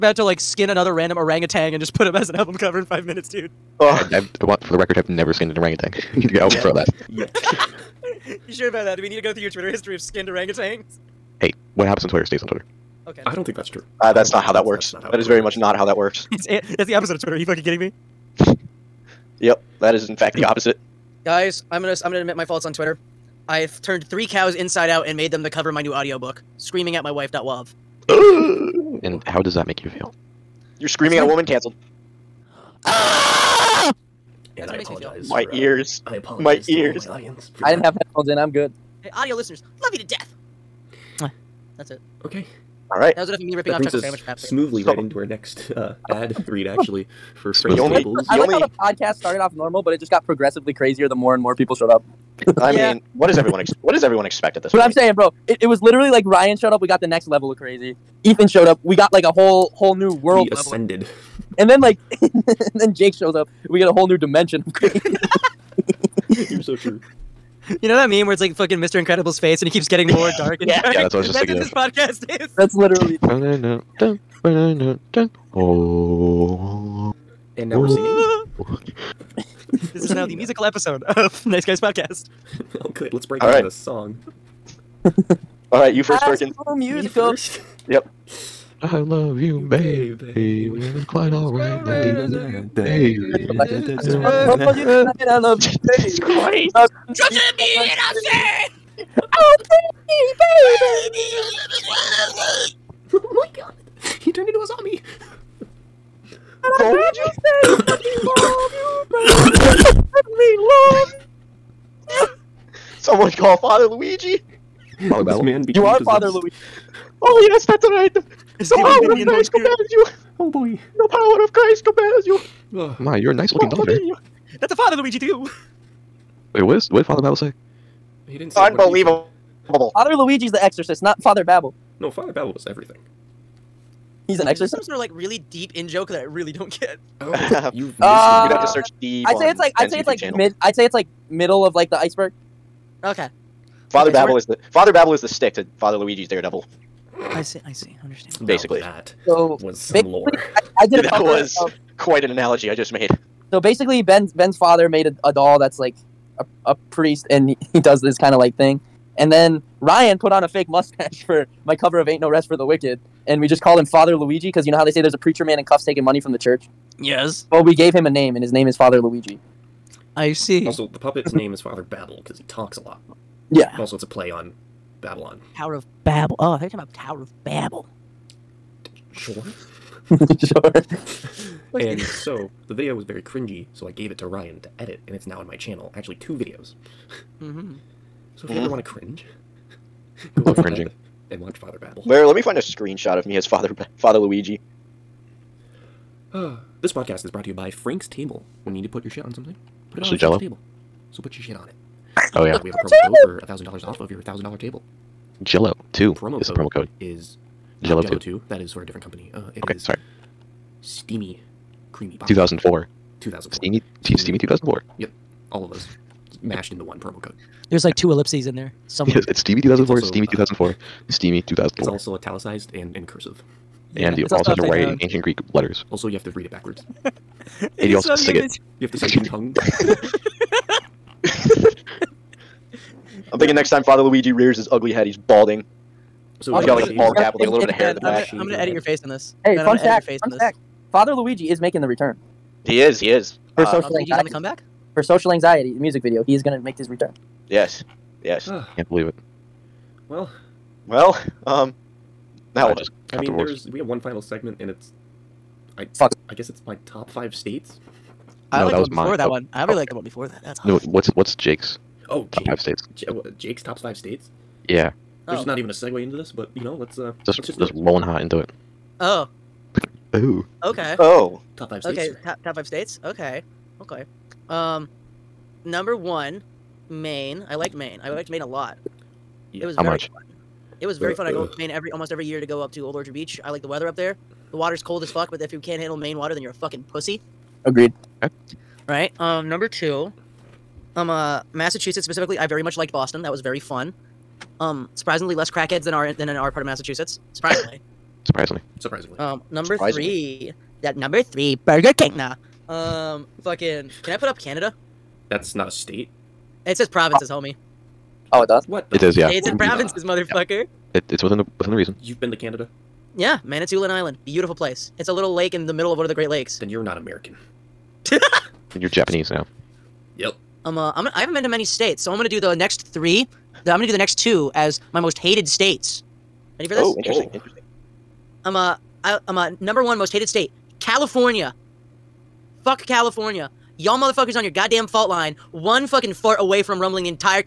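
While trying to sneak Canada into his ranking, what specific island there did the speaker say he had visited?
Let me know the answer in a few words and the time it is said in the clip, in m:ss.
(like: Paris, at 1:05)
Manitoulin Island, at 5:13.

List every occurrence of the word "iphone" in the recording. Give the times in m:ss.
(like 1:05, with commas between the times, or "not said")
not said.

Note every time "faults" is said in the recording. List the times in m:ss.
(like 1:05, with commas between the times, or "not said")
0:22, 5:34.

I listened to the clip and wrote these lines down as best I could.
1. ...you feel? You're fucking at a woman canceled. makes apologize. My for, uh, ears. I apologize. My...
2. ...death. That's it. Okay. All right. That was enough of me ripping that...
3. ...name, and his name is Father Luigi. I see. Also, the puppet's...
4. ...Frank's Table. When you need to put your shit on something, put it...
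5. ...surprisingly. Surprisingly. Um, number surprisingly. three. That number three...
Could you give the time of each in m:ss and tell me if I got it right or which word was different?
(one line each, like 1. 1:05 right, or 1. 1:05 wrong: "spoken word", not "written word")
1. 0:29 wrong: "screaming", not "fucking"
2. 0:40 right
3. 2:48 right
4. 3:17 right
5. 4:58 right.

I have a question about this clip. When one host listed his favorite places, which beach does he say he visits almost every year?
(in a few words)
Old Orchard Beach.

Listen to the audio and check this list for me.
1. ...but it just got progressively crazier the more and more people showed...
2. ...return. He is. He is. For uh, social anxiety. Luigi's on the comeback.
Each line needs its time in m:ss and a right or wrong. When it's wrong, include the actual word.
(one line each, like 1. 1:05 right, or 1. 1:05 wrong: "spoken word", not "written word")
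1. 0:49 right
2. 4:01 right.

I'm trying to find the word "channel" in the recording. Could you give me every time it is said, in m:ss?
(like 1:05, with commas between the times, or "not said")
2:20, 3:05.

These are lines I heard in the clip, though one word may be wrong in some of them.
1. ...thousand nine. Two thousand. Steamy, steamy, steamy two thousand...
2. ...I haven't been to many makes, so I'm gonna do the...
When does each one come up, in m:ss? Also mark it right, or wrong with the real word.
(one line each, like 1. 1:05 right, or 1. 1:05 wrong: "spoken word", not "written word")
1. 3:32 wrong: "four", not "nine"
2. 5:21 wrong: "states", not "makes".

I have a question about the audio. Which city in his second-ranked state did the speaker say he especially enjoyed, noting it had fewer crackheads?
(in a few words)
Boston.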